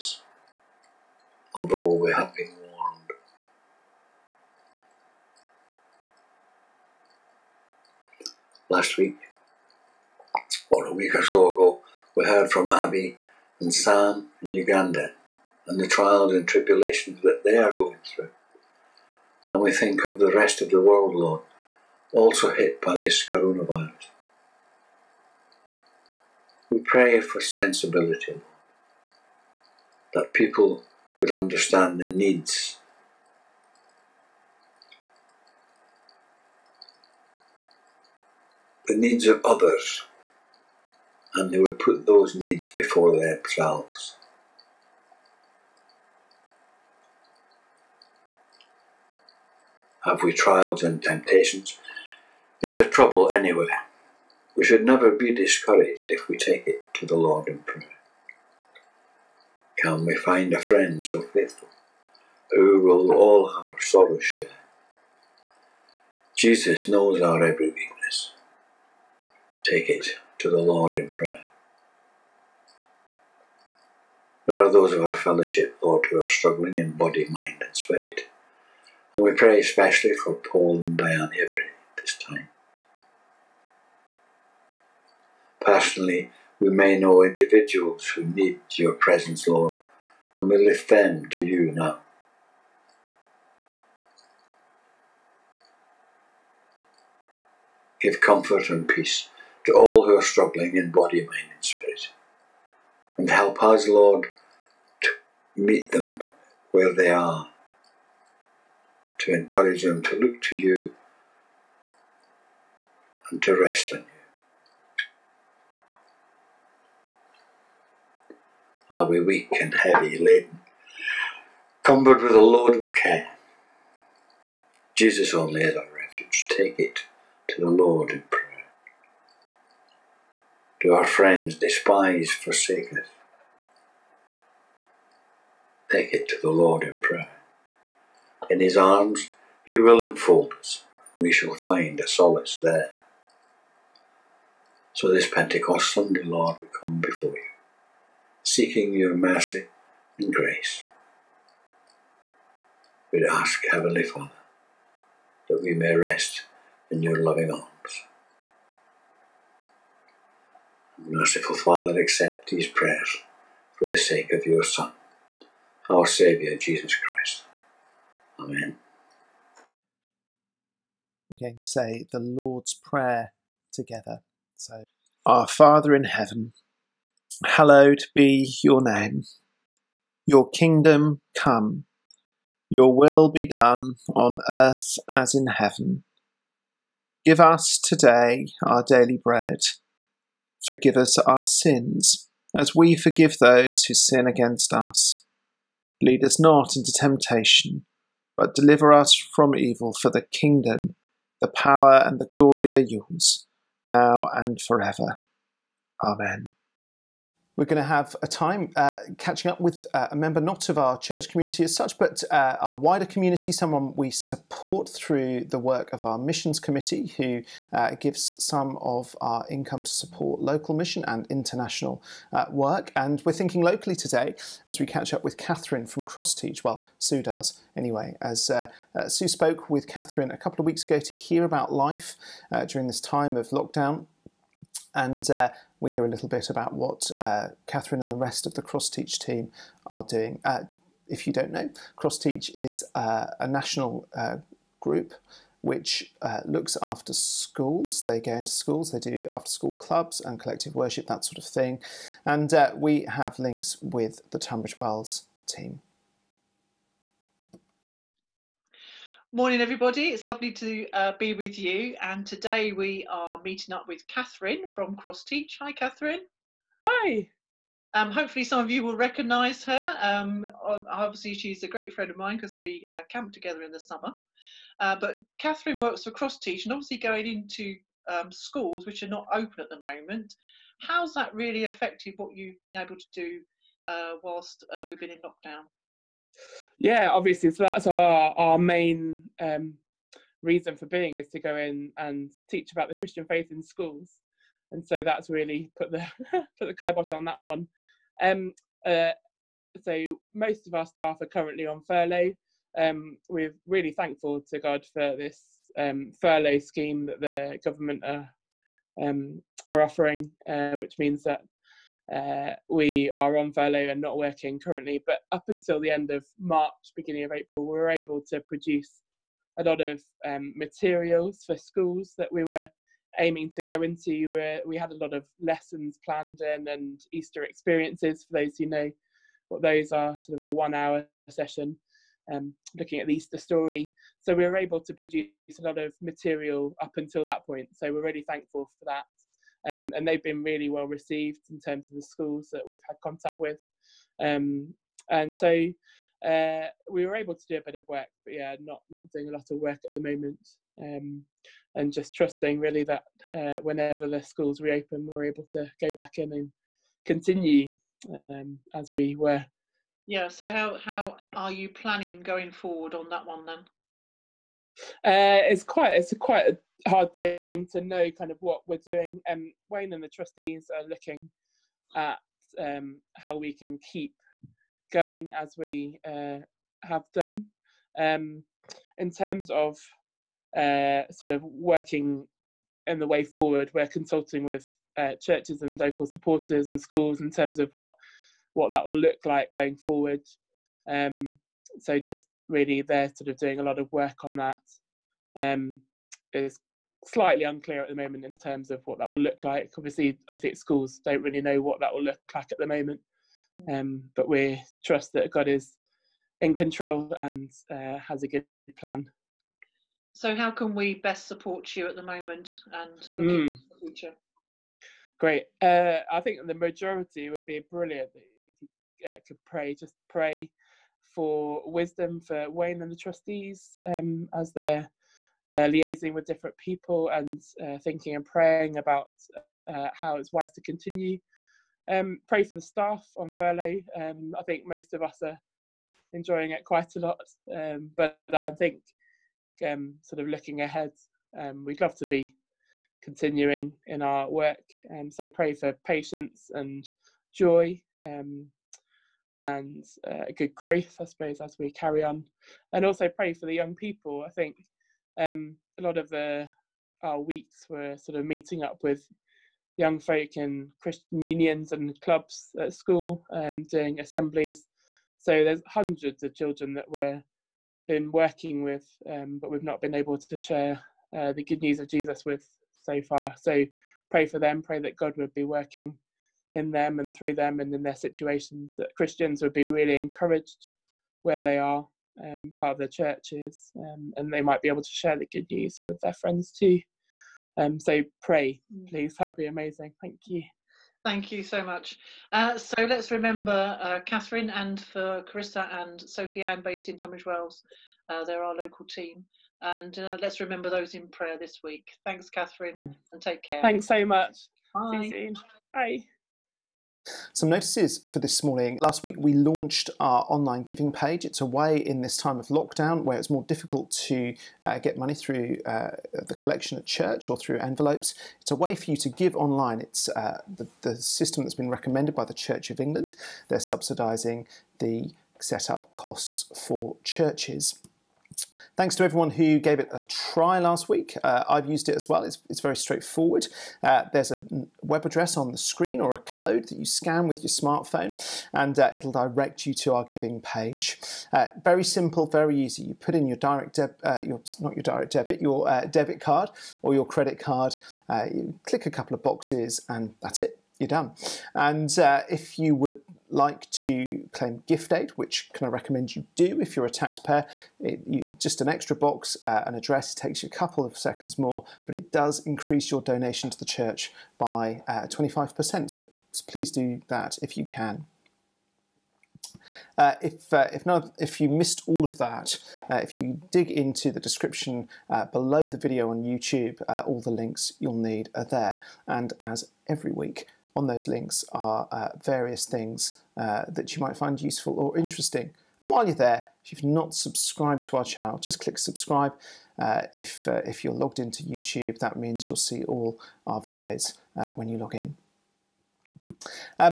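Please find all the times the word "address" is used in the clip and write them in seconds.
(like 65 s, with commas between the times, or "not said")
535 s, 559 s.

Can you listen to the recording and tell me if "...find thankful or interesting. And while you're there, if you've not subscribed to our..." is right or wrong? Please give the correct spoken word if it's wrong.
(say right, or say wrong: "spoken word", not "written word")
wrong: "useful", not "thankful".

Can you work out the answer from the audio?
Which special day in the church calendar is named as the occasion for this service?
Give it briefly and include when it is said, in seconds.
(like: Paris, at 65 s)
Pentecost Sunday, at 145 s.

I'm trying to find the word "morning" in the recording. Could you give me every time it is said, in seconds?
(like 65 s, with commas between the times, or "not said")
259 s, 508 s.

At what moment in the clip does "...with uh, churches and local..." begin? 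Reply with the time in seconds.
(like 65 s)
384 s.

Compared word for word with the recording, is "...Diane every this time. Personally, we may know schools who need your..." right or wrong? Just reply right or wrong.
wrong.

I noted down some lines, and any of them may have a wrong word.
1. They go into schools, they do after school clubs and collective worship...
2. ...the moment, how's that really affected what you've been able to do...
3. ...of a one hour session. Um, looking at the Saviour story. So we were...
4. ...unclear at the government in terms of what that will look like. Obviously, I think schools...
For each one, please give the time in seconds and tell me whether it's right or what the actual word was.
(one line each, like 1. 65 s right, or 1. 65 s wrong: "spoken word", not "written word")
1. 248 s right
2. 279 s right
3. 330 s wrong: "Easter", not "Saviour"
4. 397 s wrong: "moment", not "government".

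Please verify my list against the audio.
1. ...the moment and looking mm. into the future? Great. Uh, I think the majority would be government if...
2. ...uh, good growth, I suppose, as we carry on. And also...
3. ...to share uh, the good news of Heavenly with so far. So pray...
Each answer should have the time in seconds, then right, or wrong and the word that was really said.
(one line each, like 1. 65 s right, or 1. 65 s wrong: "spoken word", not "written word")
1. 411 s wrong: "brilliant", not "government"
2. 450 s right
3. 470 s wrong: "Jesus", not "Heavenly".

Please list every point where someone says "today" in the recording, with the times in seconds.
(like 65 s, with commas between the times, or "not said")
187 s, 223 s, 262 s.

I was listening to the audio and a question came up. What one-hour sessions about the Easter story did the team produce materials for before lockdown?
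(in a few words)
Easter experiences.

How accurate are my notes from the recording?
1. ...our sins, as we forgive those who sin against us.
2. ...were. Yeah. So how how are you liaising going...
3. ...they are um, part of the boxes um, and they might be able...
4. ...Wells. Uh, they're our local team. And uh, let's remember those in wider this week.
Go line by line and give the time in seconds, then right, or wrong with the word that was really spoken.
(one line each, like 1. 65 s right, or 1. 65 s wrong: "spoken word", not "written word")
1. 191 s right
2. 359 s wrong: "planning", not "liaising"
3. 481 s wrong: "churches", not "boxes"
4. 497 s wrong: "prayer", not "wider".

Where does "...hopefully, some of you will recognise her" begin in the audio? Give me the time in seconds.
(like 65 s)
268 s.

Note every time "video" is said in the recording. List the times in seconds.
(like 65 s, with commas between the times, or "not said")
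575 s, 593 s.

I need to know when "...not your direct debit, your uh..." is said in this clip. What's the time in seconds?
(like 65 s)
544 s.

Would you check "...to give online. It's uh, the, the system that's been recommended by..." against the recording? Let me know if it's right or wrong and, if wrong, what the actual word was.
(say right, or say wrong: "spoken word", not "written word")
right.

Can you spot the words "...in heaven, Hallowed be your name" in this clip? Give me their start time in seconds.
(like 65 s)
175 s.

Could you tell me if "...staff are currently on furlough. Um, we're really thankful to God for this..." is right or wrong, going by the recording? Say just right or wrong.
right.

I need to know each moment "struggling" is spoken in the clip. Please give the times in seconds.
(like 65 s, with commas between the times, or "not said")
76 s, 100 s.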